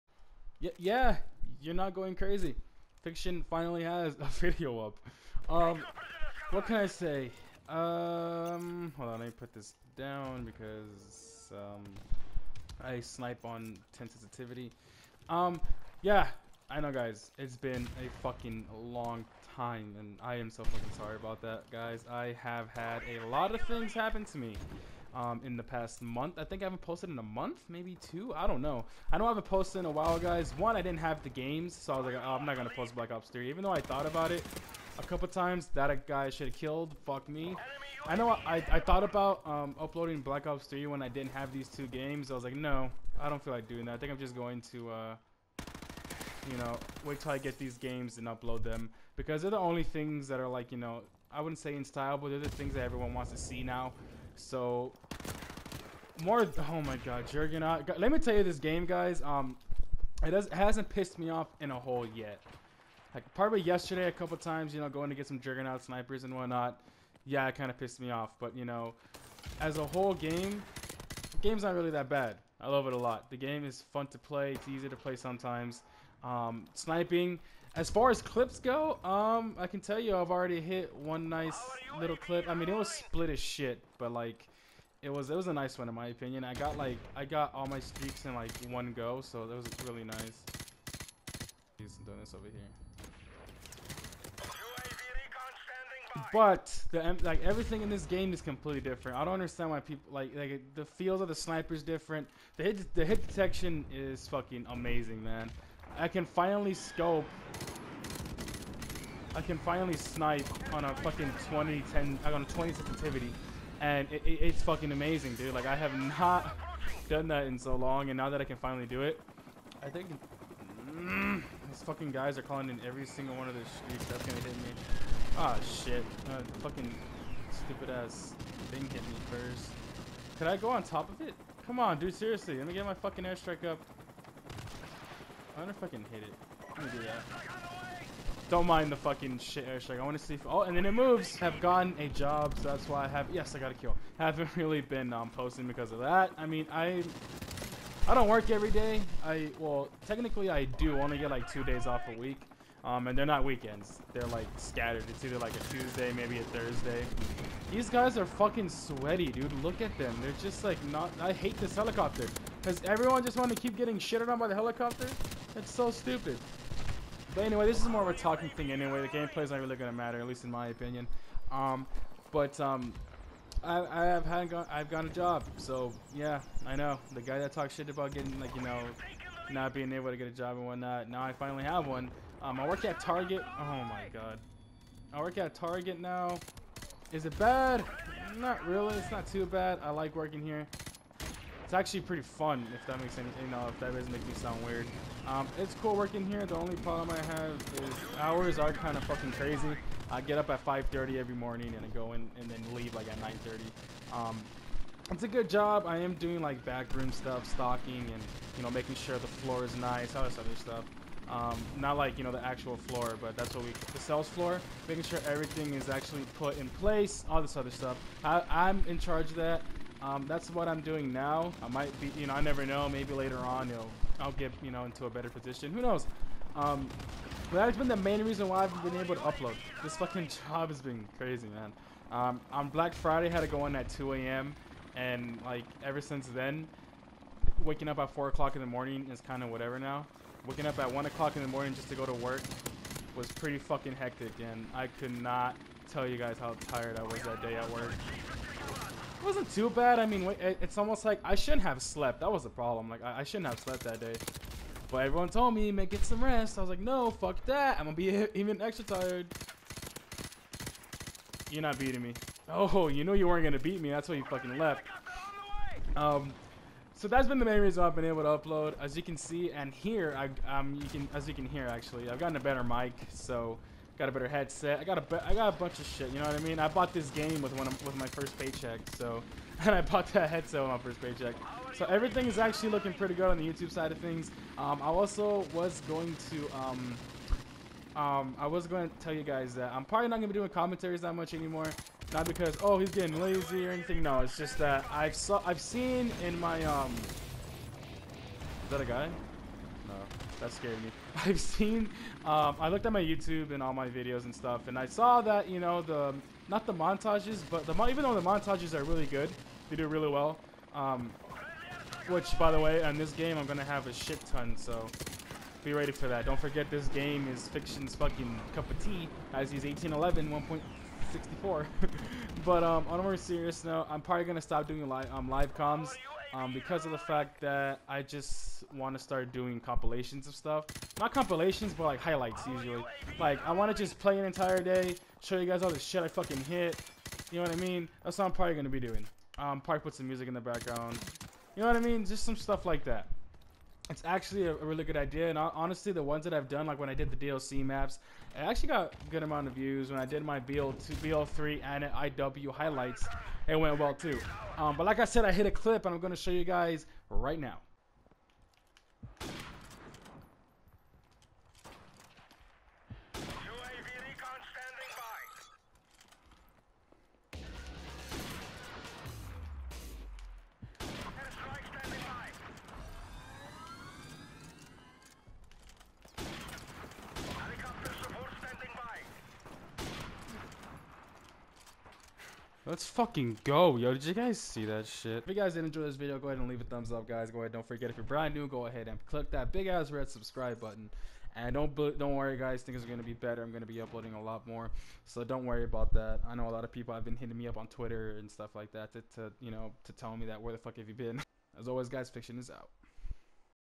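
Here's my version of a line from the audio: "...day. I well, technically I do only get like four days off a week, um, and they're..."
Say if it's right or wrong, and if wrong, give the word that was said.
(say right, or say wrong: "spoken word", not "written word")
wrong: "two", not "four".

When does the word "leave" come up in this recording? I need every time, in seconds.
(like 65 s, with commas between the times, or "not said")
202 s, 386 s.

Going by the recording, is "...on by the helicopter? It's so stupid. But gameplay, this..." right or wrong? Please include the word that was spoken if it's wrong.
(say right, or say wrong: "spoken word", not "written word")
wrong: "anyway", not "gameplay".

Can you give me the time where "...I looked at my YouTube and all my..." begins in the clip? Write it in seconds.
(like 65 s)
302 s.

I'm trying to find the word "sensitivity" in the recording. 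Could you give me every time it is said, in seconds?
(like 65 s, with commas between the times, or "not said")
14 s, 112 s.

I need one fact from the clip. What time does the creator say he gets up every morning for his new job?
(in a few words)
5:30.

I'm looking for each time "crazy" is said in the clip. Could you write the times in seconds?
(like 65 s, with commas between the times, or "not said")
2 s, 199 s, 231 s.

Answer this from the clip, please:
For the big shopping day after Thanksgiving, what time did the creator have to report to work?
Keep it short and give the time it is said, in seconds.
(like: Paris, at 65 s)
2 a.m., at 233 s.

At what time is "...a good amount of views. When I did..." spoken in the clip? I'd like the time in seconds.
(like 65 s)
348 s.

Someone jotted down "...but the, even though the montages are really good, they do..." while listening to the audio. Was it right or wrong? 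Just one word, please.
right.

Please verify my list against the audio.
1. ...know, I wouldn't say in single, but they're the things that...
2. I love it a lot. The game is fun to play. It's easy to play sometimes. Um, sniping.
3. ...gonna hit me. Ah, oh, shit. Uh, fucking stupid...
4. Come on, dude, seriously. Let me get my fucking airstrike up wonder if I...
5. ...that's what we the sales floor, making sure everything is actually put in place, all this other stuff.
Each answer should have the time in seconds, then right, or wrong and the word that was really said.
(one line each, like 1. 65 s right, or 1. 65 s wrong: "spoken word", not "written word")
1. 50 s wrong: "style", not "single"
2. 72 s right
3. 124 s right
4. 131 s right
5. 213 s right.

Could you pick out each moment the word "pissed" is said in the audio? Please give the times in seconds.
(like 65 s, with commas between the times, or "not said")
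60 s, 67 s.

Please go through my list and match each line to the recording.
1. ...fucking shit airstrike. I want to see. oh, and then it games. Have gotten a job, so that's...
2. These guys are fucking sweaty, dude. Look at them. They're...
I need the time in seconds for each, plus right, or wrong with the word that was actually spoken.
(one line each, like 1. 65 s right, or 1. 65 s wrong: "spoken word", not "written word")
1. 138 s wrong: "moves", not "games"
2. 157 s right.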